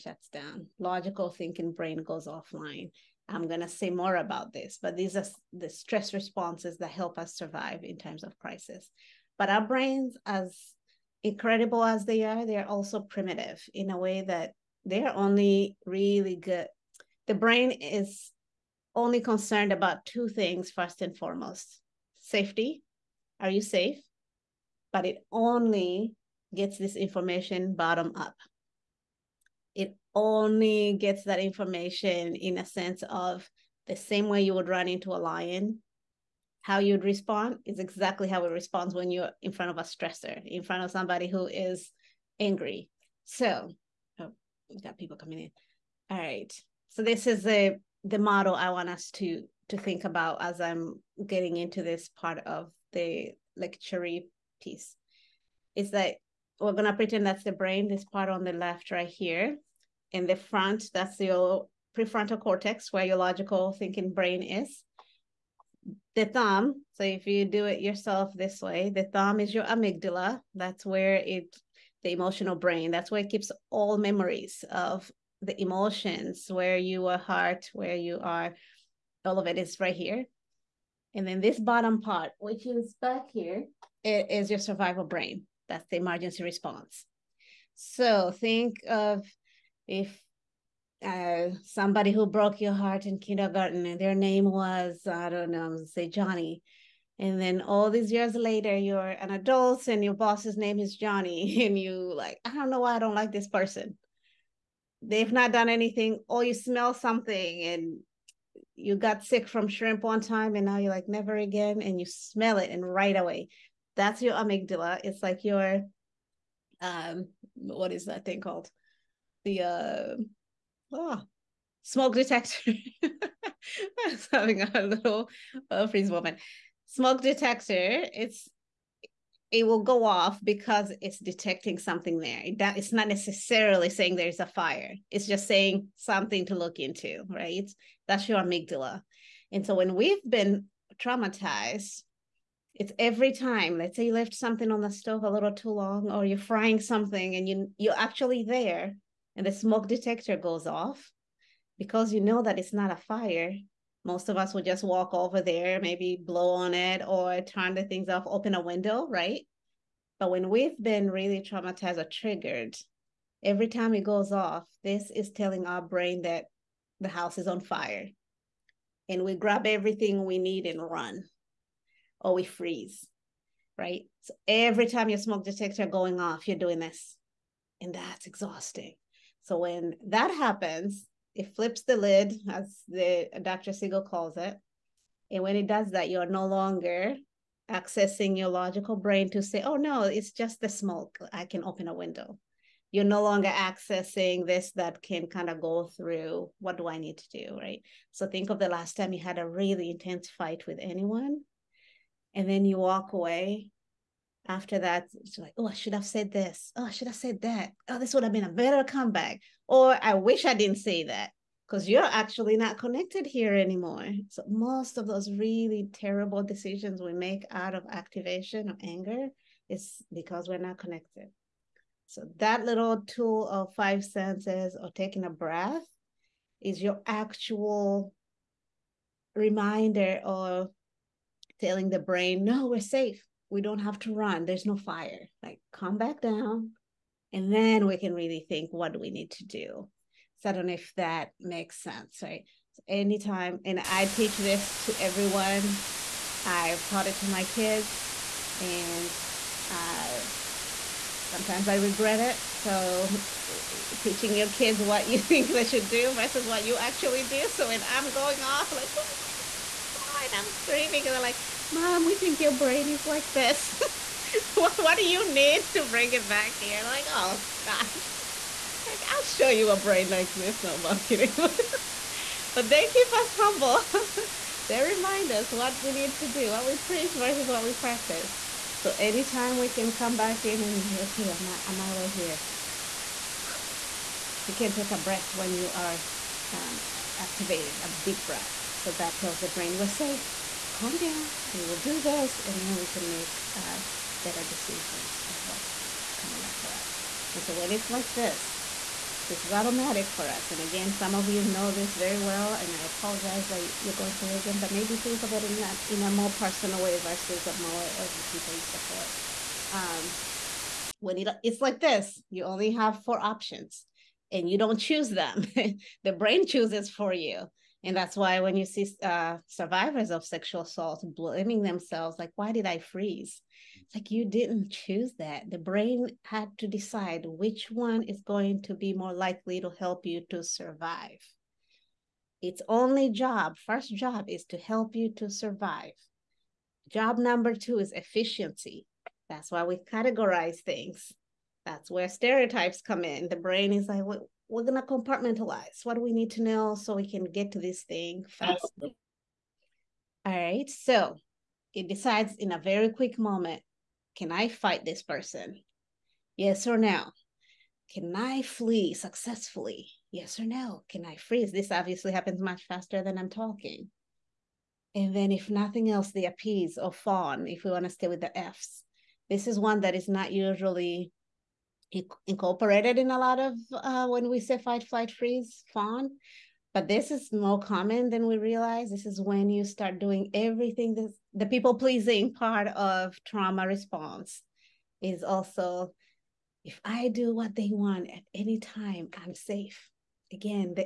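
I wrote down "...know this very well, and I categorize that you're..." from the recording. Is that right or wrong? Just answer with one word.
wrong.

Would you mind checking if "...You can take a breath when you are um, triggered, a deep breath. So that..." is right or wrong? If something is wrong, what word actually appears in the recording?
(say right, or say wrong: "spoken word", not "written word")
wrong: "activated", not "triggered".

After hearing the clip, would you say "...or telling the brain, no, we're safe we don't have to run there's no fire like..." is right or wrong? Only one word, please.
right.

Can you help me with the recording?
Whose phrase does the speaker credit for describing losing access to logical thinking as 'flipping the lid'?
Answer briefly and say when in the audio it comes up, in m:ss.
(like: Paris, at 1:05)
Dr. Siegel, at 3:03.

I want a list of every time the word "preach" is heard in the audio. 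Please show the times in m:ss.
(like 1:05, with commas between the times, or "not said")
4:36.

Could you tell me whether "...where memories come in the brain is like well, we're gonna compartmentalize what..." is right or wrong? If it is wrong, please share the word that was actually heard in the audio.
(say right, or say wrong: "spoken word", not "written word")
wrong: "stereotypes", not "memories".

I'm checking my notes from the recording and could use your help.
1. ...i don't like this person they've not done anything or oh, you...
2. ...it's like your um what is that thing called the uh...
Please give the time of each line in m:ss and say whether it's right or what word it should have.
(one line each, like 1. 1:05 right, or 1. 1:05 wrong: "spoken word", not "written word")
1. 1:42 right
2. 1:55 right.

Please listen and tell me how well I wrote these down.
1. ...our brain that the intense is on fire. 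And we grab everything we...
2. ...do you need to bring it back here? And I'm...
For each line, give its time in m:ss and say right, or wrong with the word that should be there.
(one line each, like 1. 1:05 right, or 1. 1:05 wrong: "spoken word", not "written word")
1. 2:45 wrong: "house", not "intense"
2. 4:24 right.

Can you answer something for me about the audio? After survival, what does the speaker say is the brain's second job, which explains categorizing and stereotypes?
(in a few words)
Efficiency.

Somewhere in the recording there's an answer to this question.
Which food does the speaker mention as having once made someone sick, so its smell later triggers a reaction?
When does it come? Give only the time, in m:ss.
1:49.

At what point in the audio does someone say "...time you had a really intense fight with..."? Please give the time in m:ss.
3:18.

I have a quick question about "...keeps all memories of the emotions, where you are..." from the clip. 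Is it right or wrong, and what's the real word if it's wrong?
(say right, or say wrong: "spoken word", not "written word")
right.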